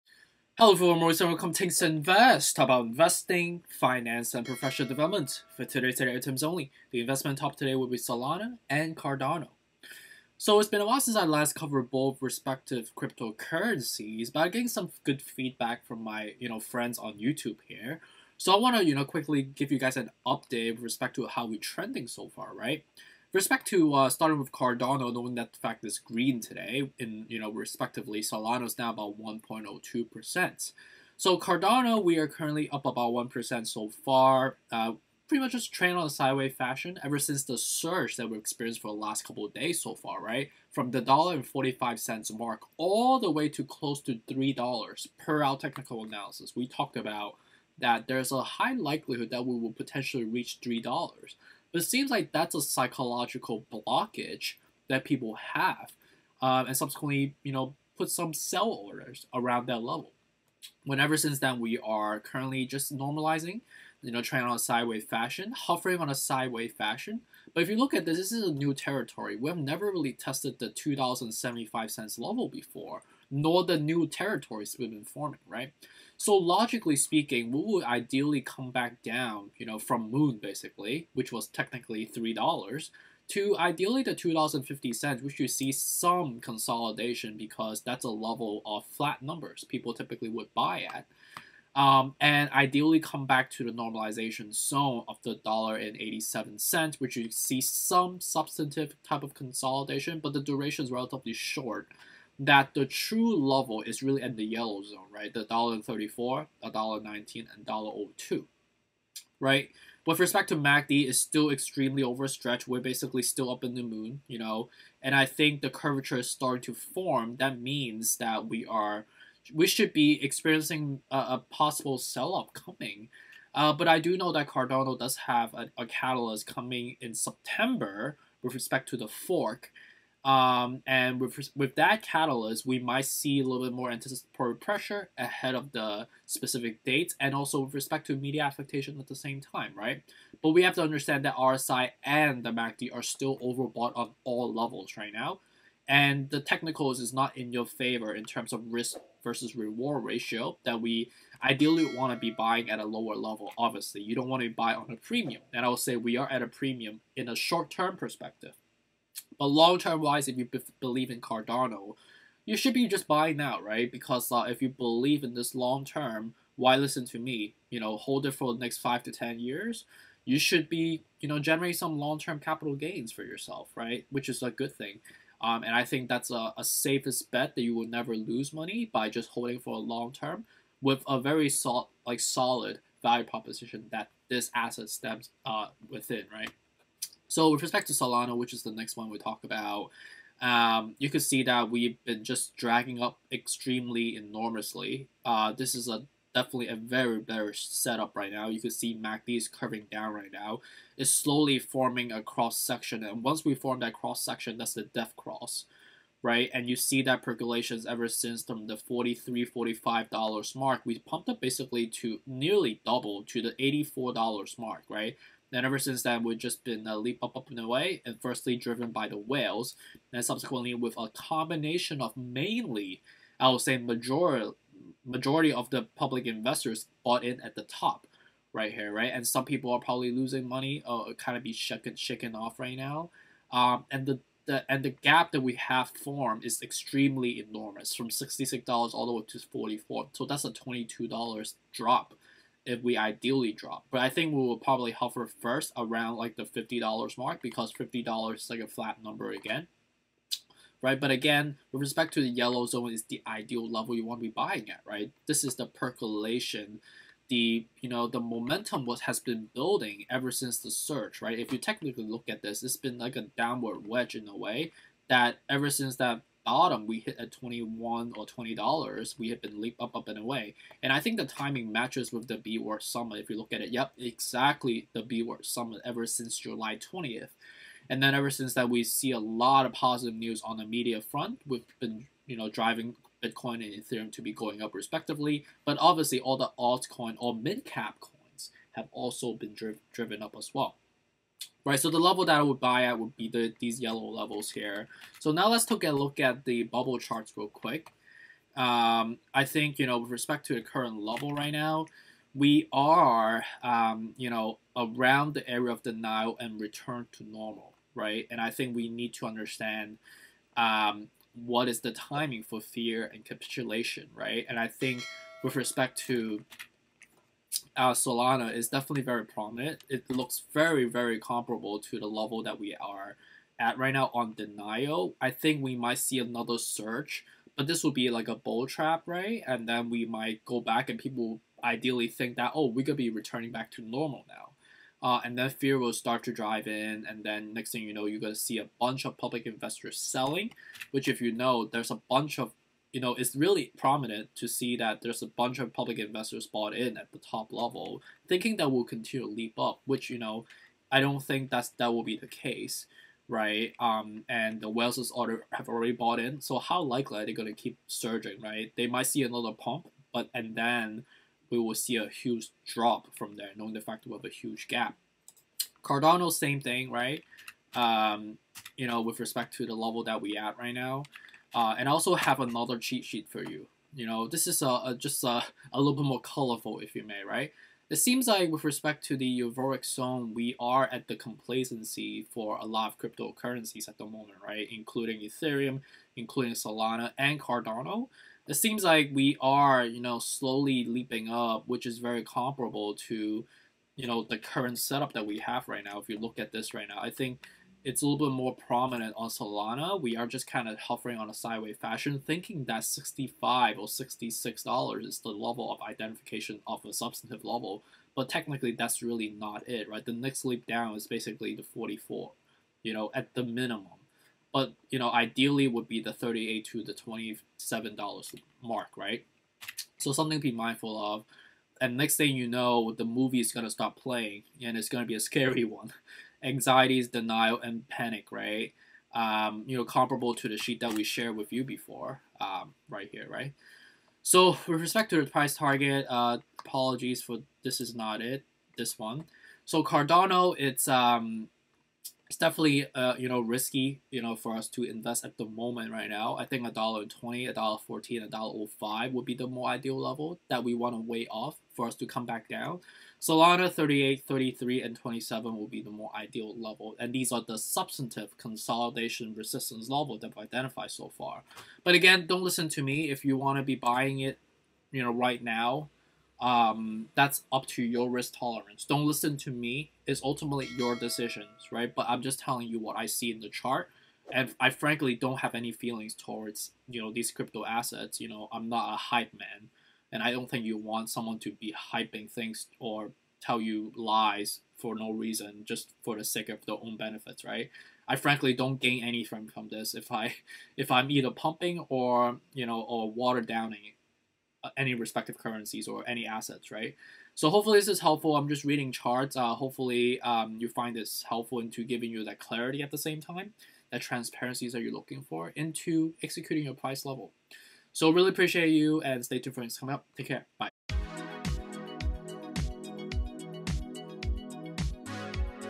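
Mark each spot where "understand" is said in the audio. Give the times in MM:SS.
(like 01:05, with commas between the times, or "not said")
02:20, 05:09.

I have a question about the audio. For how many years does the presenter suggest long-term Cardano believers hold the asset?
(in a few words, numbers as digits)
5 to 10 years.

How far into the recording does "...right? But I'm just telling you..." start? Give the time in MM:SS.
07:51.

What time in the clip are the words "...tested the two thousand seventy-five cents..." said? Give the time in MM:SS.
01:10.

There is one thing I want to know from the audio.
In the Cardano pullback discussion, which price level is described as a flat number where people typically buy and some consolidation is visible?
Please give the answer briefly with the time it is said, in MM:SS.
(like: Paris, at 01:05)
$2.50, at 01:24.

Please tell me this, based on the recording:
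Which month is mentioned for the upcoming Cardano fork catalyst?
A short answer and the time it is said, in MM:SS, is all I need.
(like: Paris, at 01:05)
September, at 02:07.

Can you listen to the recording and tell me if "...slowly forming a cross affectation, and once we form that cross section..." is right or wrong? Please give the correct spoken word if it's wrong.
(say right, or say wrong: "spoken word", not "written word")
wrong: "section", not "affectation".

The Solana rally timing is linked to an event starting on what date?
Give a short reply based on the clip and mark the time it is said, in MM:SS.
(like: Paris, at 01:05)
July 20th, at 04:36.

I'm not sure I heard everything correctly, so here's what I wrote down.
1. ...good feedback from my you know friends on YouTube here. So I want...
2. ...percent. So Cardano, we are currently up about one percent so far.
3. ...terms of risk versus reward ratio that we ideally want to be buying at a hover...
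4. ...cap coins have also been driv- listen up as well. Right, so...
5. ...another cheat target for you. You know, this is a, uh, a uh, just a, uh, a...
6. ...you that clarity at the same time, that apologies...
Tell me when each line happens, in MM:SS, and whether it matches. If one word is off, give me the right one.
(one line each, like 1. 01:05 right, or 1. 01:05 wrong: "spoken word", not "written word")
1. 00:15 right
2. 00:30 right
3. 02:28 wrong: "lower", not "hover"
4. 04:47 wrong: "driven", not "listen"
5. 06:12 wrong: "sheet", not "target"
6. 08:22 wrong: "transparencies", not "apologies".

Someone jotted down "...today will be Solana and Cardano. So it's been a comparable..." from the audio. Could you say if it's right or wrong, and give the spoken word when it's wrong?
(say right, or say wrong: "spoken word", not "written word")
wrong: "while", not "comparable".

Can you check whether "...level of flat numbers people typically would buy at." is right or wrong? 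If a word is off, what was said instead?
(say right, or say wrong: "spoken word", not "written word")
right.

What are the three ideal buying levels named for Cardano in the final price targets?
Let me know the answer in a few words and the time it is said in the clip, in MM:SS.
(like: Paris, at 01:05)
$1.20, $1.14, $1.05, at 07:26.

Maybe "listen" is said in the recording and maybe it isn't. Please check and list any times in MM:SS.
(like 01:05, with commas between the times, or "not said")
02:46, 07:42, 07:49.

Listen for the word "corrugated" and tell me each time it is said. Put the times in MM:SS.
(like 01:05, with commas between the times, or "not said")
not said.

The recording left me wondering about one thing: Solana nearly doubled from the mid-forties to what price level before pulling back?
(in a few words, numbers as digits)
$84.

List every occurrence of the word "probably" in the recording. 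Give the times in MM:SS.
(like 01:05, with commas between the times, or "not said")
03:49, 04:04.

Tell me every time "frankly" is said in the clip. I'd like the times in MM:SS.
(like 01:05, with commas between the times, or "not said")
07:54, 08:08.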